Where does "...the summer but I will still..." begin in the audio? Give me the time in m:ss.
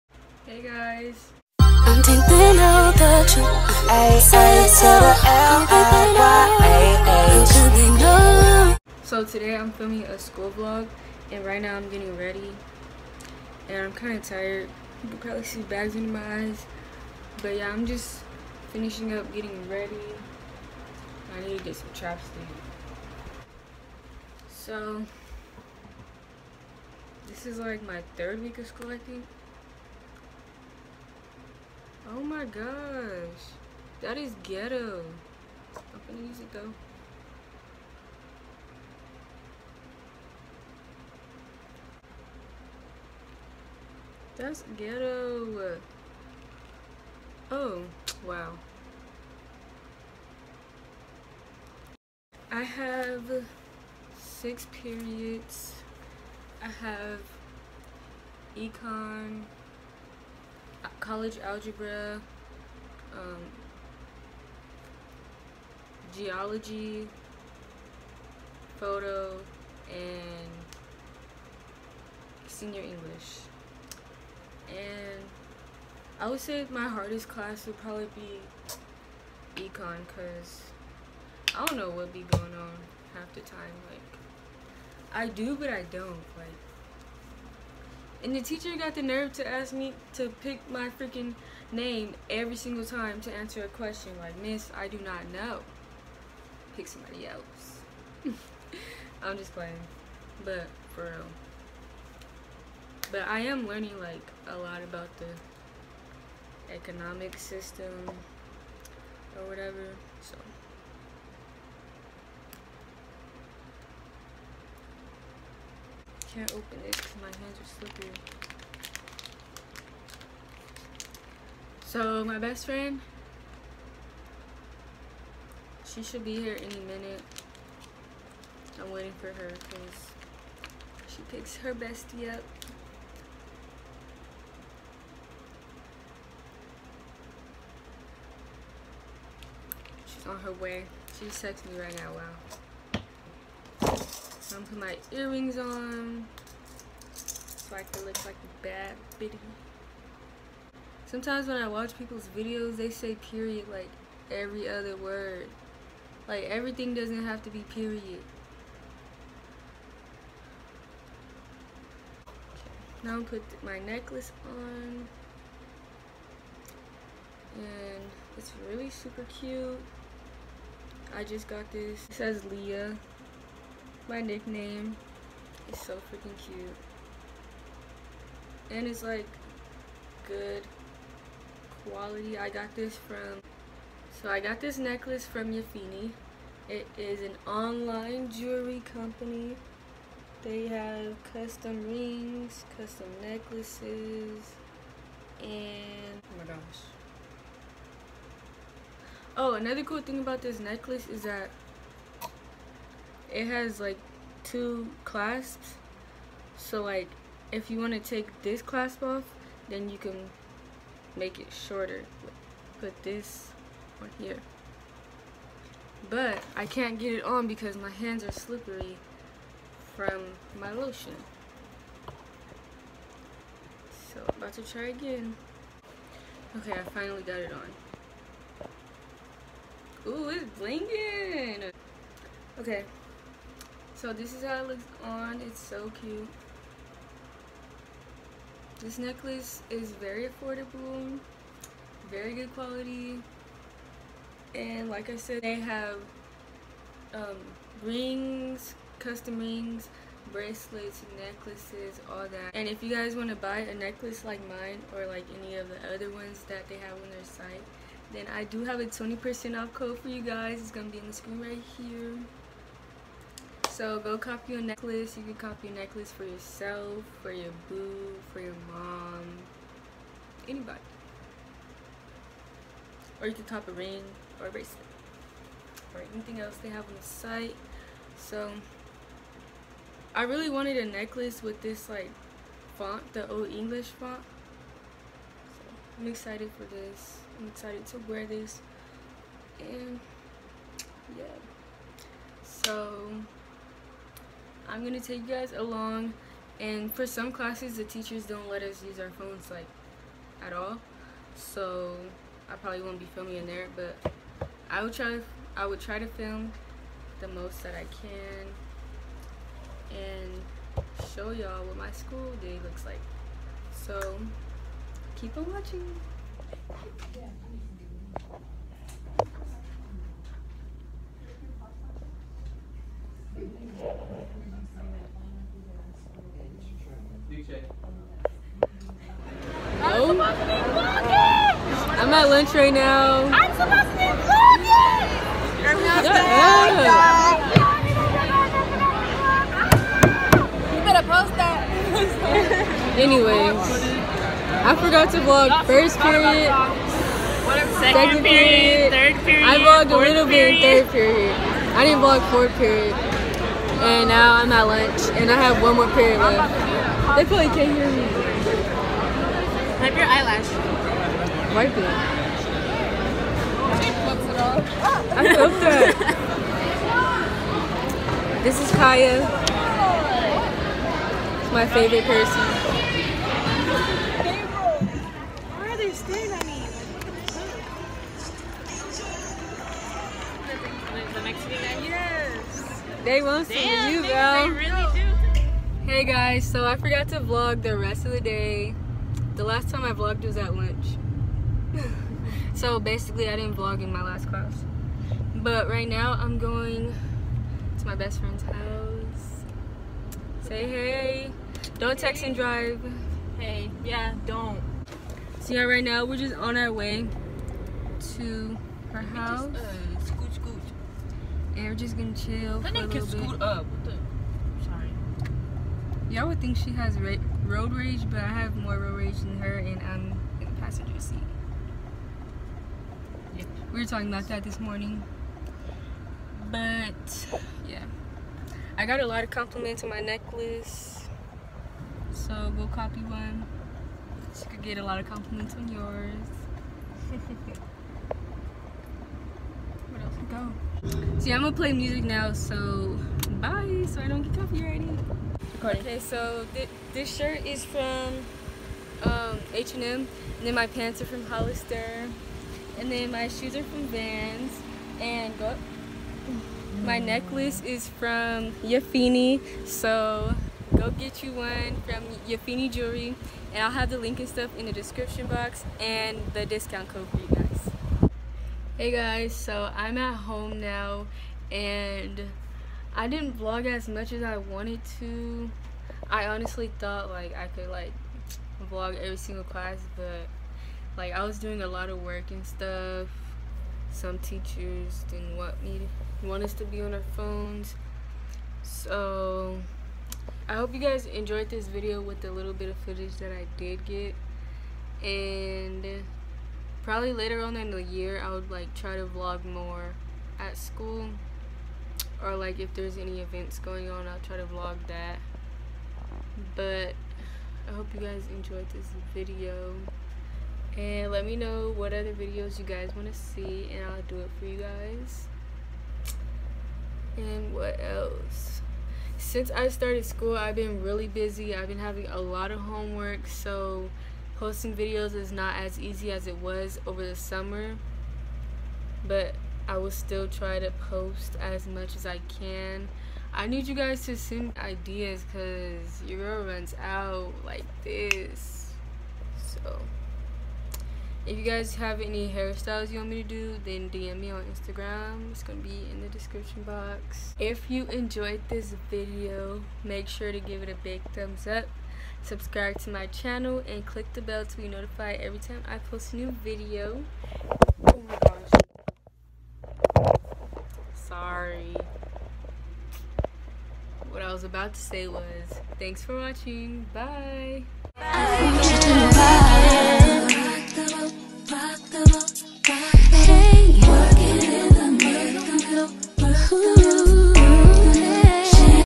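8:47.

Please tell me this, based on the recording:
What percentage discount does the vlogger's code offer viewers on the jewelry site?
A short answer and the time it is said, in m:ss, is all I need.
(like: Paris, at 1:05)
20%, at 4:18.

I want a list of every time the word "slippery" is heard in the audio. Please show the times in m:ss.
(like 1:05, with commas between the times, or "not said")
1:57, 3:38.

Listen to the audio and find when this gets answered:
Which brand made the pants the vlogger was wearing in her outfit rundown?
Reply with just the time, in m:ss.
7:31.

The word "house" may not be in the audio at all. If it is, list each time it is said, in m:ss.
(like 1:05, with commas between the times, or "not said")
6:38, 6:49.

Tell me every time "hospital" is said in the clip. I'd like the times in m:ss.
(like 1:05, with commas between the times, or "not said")
not said.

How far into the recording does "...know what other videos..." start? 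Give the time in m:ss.
8:31.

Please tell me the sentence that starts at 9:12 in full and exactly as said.
Subscribe to my channel and click the bell to be notified every time I post a new video.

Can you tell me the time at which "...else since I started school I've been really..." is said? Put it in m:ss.
8:37.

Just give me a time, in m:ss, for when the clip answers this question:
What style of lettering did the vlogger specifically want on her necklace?
4:43.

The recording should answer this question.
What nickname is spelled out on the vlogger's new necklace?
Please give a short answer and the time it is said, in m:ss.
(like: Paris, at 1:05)
Leah, at 2:52.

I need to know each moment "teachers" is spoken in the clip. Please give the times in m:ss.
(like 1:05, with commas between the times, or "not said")
1:28, 4:57, 8:04.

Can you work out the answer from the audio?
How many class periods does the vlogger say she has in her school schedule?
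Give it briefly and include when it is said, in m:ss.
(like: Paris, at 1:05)
6, at 0:54.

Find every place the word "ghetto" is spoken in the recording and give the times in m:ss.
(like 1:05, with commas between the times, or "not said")
0:34, 0:44.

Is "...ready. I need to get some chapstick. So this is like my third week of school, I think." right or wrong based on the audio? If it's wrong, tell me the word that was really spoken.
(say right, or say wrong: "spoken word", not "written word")
right.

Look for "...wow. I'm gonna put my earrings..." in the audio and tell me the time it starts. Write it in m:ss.
2:22.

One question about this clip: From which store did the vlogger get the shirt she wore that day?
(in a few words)
H&M.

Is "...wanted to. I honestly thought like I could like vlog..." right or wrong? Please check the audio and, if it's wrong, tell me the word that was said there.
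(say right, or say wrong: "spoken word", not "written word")
right.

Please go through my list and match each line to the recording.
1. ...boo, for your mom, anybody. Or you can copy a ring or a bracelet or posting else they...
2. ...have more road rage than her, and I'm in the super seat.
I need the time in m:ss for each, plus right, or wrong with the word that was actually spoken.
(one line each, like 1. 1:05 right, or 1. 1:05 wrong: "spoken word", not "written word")
1. 4:27 wrong: "anything", not "posting"
2. 6:58 wrong: "passenger", not "super".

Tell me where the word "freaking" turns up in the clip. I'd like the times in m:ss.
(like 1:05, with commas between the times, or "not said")
1:30, 2:56.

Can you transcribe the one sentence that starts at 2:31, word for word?
Sometimes when I watch people's videos, they say period like every other word.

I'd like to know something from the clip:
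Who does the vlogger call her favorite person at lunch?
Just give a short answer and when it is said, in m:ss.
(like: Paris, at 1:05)
Kaya, at 6:08.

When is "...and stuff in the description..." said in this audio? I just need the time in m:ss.
7:44.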